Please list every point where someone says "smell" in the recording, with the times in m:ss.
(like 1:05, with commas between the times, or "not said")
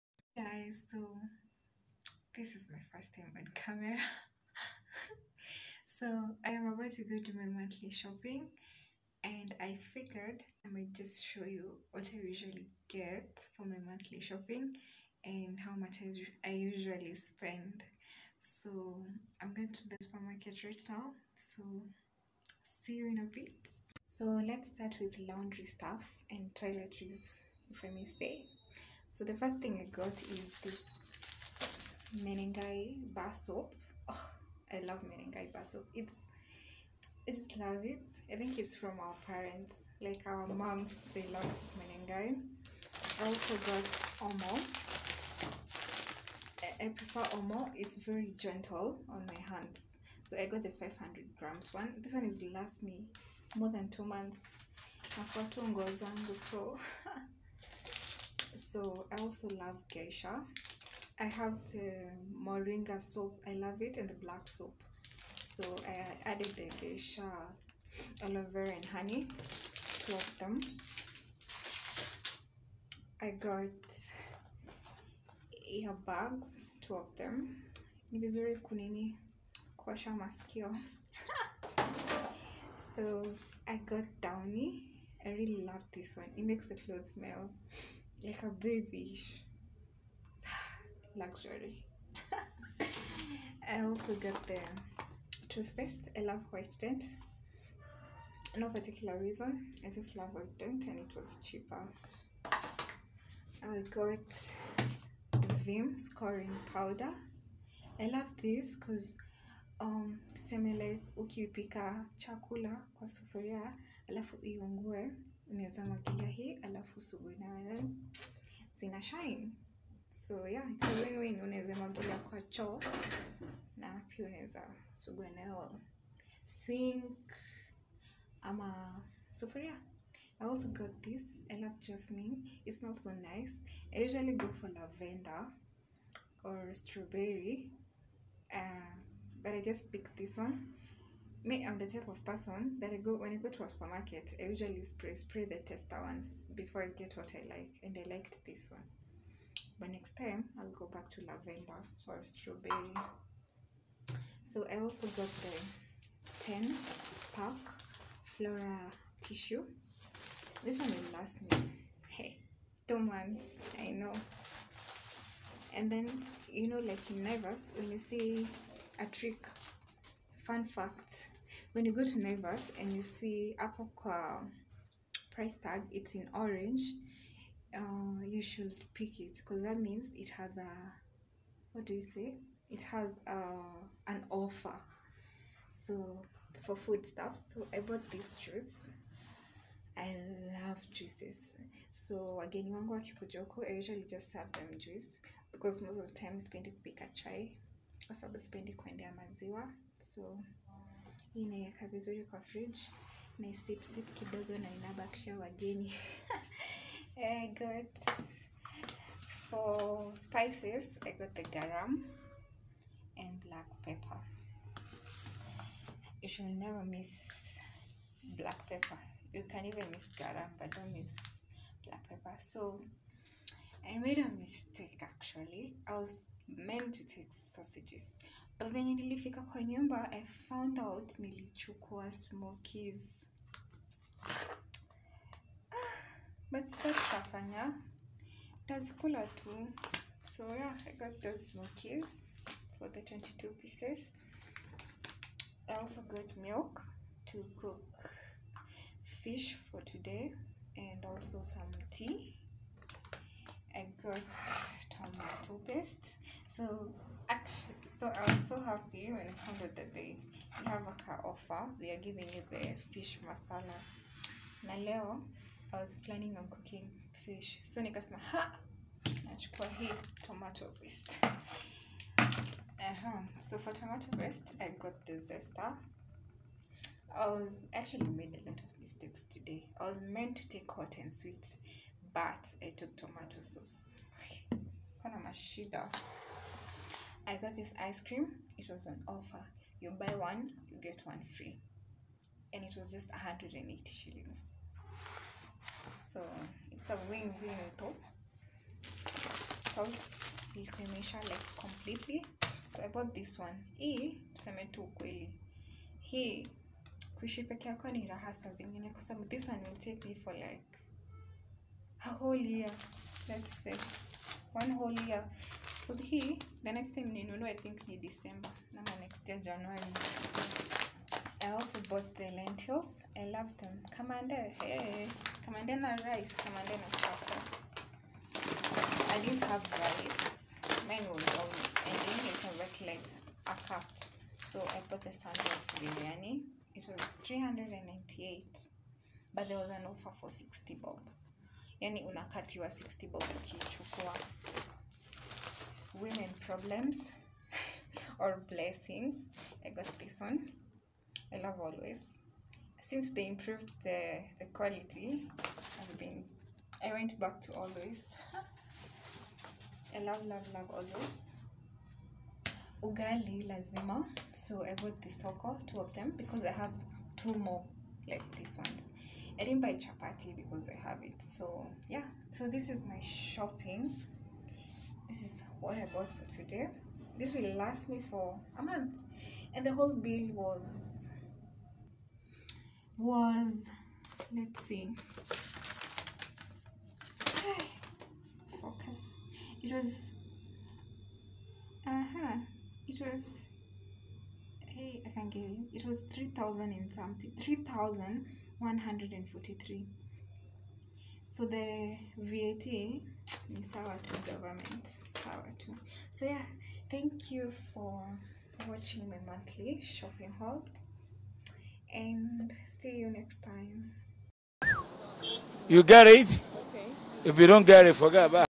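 1:27, 2:12.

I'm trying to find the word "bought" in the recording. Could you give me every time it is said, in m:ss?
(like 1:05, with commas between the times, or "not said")
3:07, 5:02, 5:21, 5:34, 6:04, 6:15.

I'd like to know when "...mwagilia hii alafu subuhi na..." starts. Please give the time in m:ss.
1:55.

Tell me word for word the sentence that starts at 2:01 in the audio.
Unaweza mwagilia kwa choo na pia unaweza sugua nayo sink ama sufuria.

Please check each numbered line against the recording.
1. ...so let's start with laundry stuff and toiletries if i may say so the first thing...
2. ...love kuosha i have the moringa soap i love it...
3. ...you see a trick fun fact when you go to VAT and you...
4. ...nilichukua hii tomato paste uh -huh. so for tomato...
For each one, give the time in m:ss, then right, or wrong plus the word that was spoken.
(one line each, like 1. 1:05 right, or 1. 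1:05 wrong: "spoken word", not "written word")
1. 0:24 right
2. 0:59 wrong: "geisha", not "kuosha"
3. 2:47 wrong: "Naivas", not "VAT"
4. 4:29 wrong: "nachukua", not "nilichukua".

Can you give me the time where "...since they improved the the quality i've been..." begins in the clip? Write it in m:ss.
5:52.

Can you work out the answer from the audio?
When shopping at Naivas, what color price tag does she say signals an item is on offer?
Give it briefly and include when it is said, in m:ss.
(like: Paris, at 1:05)
Orange, at 2:56.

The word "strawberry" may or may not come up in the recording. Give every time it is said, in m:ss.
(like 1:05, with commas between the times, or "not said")
2:16, 2:32.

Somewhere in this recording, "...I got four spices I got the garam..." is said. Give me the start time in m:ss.
3:27.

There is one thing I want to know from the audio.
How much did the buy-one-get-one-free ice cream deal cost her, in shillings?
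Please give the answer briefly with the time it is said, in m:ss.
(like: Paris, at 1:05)
180 shillings, at 4:53.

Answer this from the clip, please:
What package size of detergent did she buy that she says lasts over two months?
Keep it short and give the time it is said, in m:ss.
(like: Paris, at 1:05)
500 grams, at 0:50.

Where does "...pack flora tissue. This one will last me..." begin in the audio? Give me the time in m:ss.
2:37.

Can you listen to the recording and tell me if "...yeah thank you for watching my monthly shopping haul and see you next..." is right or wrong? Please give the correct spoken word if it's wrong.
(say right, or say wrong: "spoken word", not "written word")
right.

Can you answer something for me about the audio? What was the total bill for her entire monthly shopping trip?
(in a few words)
3,143.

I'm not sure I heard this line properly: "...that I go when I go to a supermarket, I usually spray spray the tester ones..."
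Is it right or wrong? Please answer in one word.
right.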